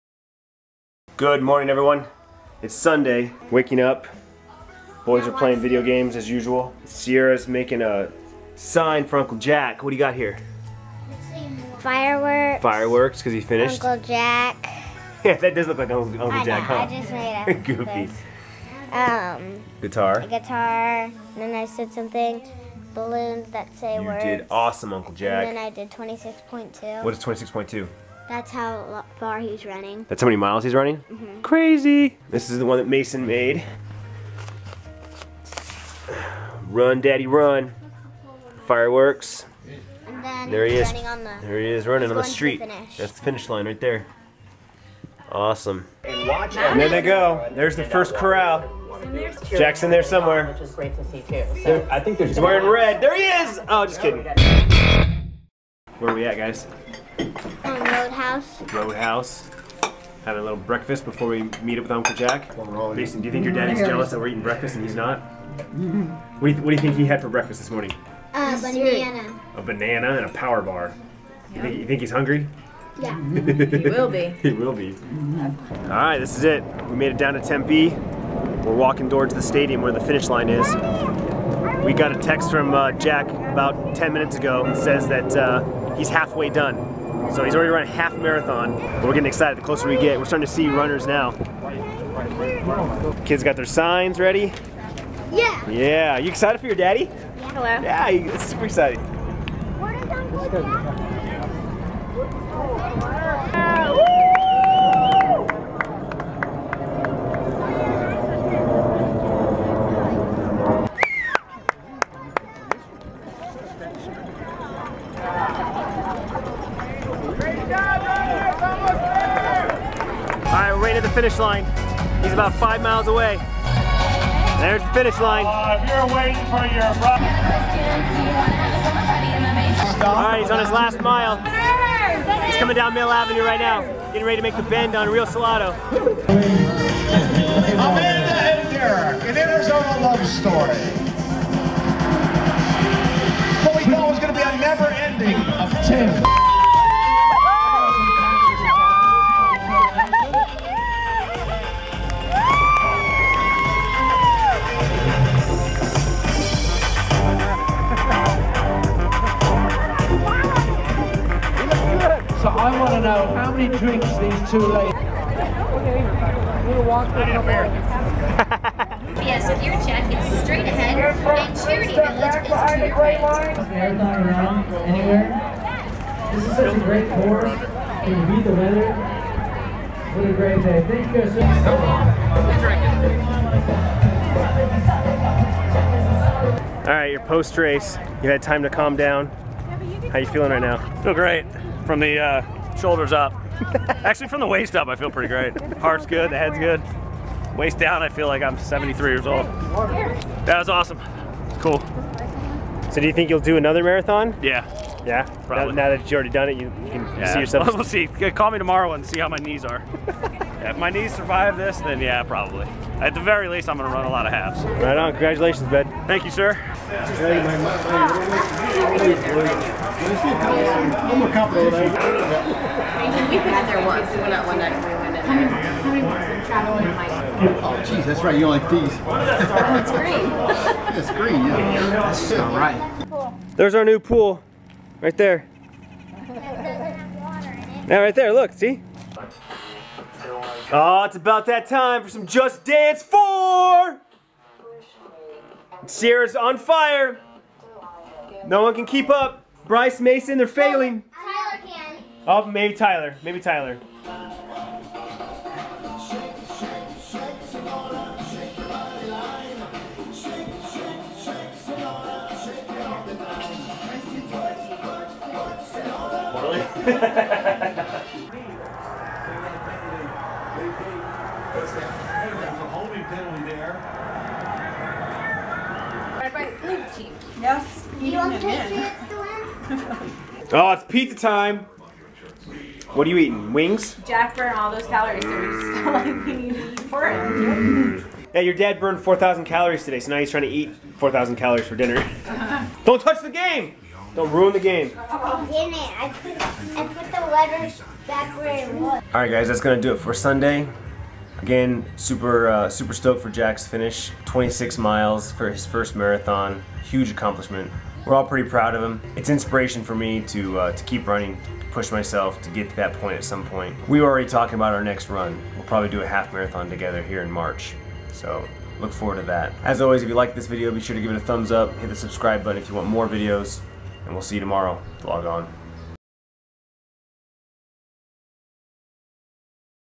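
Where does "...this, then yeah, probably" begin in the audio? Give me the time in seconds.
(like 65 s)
211 s.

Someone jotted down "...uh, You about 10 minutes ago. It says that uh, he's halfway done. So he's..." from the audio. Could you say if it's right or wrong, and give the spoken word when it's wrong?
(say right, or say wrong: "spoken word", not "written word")
wrong: "Jack", not "You".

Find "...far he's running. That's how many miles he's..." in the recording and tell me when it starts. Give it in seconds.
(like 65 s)
29 s.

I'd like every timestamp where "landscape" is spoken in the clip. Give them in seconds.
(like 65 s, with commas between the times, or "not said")
not said.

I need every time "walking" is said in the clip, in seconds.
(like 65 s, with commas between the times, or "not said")
78 s, 166 s.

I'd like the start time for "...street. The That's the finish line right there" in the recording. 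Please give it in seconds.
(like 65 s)
42 s.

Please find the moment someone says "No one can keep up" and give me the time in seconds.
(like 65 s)
248 s.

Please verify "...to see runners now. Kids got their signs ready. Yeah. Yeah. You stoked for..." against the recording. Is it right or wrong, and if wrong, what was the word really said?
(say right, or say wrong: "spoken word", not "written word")
wrong: "excited", not "stoked".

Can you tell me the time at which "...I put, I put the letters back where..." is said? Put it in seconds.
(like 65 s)
294 s.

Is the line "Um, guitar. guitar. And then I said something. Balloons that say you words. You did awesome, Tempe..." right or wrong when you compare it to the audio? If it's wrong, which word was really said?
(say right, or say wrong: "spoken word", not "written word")
wrong: "Uncle", not "Tempe".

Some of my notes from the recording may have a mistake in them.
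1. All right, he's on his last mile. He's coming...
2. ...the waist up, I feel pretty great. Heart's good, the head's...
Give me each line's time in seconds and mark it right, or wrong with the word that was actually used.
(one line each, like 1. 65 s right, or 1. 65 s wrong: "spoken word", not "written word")
1. 130 s right
2. 194 s right.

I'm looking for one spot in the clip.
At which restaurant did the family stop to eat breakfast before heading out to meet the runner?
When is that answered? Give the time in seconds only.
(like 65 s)
57 s.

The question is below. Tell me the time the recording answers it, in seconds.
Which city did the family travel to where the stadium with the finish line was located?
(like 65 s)
77 s.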